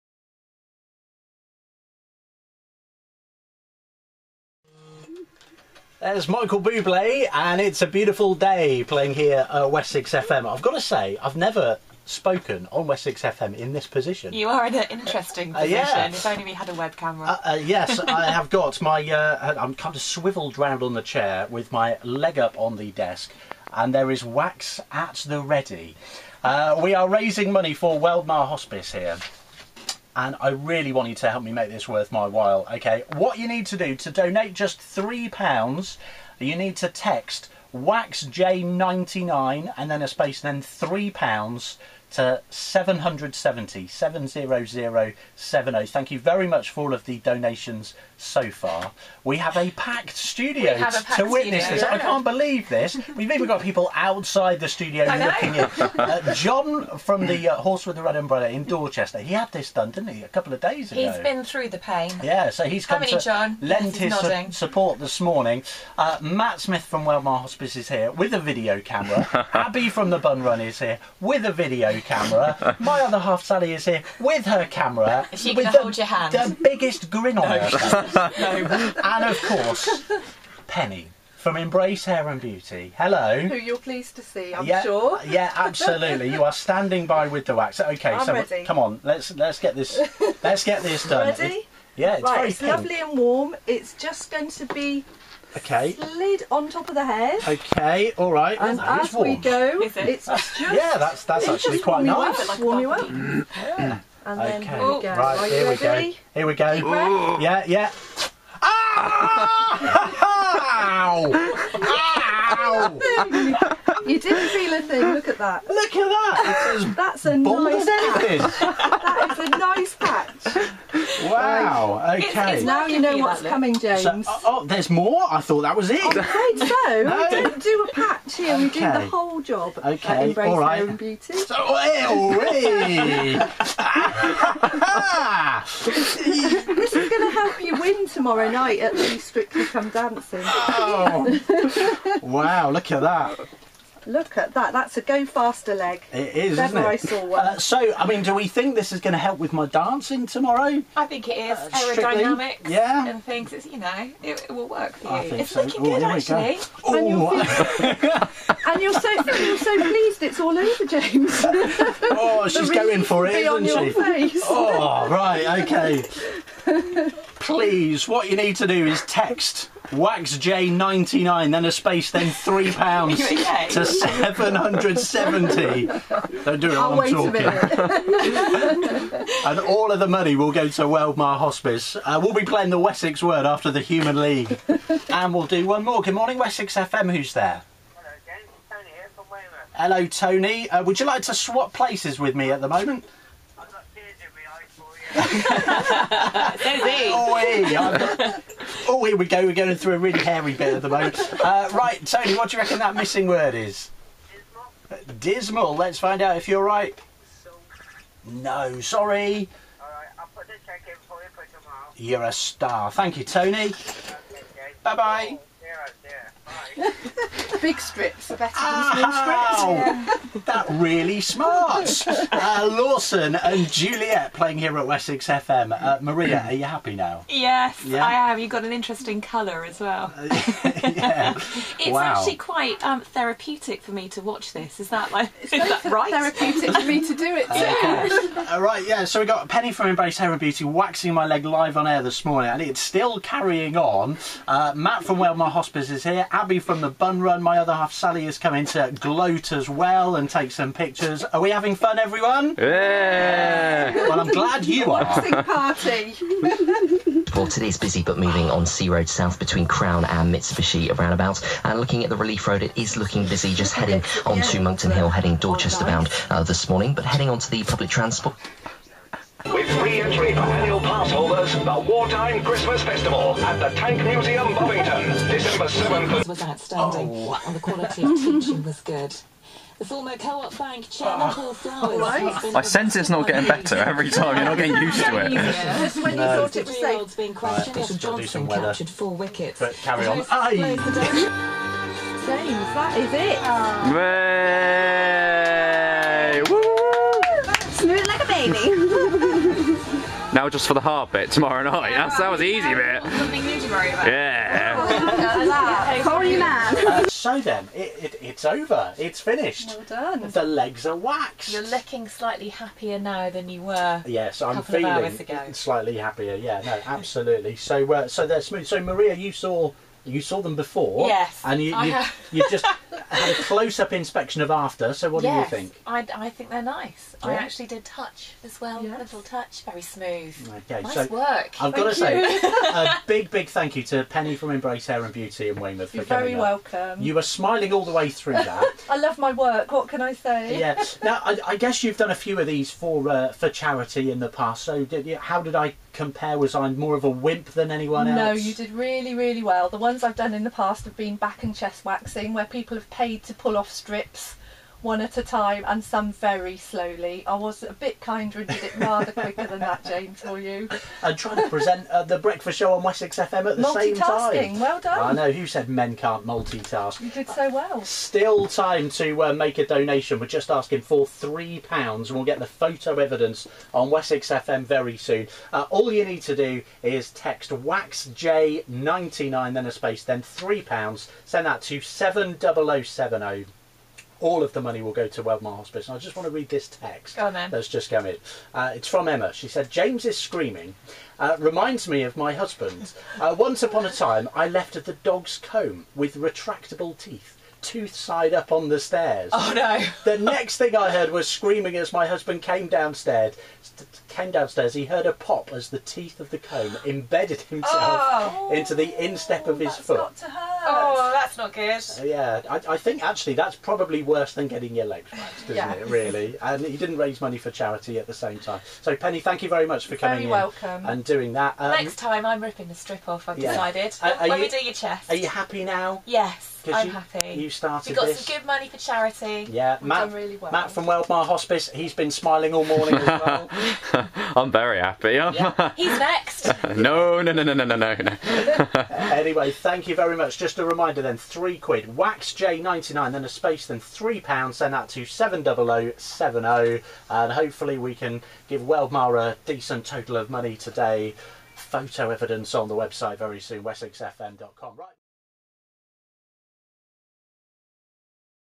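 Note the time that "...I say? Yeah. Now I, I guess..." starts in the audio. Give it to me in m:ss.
5:40.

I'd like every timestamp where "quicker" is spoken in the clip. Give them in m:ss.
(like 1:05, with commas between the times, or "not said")
5:59.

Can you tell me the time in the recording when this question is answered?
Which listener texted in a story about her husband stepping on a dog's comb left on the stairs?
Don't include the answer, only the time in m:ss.
6:29.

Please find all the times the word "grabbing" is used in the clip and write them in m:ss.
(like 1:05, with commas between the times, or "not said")
not said.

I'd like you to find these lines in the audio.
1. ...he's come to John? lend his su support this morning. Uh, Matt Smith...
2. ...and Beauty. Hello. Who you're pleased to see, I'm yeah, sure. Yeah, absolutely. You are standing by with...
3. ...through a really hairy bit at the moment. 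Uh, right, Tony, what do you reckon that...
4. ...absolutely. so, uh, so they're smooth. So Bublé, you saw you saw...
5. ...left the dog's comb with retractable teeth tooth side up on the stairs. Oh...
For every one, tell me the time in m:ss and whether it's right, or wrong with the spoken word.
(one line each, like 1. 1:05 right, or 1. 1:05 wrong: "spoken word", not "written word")
1. 1:02 right
2. 1:22 right
3. 3:19 right
4. 5:16 wrong: "Maria", not "Bublé"
5. 6:34 right.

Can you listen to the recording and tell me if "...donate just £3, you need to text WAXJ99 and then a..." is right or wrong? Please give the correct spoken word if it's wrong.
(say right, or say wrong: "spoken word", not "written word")
right.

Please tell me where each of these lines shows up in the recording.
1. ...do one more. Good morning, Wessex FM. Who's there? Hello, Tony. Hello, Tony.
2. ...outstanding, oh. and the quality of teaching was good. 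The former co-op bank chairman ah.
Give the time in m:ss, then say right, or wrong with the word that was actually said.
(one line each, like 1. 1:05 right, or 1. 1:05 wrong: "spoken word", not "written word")
1. 3:05 right
2. 4:36 right.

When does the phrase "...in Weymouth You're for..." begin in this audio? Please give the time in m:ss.
5:35.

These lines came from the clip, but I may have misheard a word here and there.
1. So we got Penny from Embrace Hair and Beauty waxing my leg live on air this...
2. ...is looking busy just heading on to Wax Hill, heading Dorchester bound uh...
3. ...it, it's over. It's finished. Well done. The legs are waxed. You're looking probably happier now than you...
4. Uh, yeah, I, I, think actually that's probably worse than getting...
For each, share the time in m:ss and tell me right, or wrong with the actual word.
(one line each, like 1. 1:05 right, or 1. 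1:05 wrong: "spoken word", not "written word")
1. 3:59 right
2. 4:22 wrong: "Monkton", not "Wax"
3. 5:08 wrong: "slightly", not "probably"
4. 6:51 right.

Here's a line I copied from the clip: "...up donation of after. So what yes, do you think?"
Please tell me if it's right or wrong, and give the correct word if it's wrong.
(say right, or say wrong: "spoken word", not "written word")
wrong: "inspection", not "donation".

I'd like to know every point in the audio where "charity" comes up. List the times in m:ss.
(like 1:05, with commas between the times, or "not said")
5:43, 6:57, 7:08.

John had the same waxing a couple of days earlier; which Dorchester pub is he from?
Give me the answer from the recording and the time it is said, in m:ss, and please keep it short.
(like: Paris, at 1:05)
Horse with the Red Umbrella, at 0:57.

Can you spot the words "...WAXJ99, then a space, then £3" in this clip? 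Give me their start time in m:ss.
6:17.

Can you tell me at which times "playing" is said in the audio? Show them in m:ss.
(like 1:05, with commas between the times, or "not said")
0:08, 3:02, 3:44.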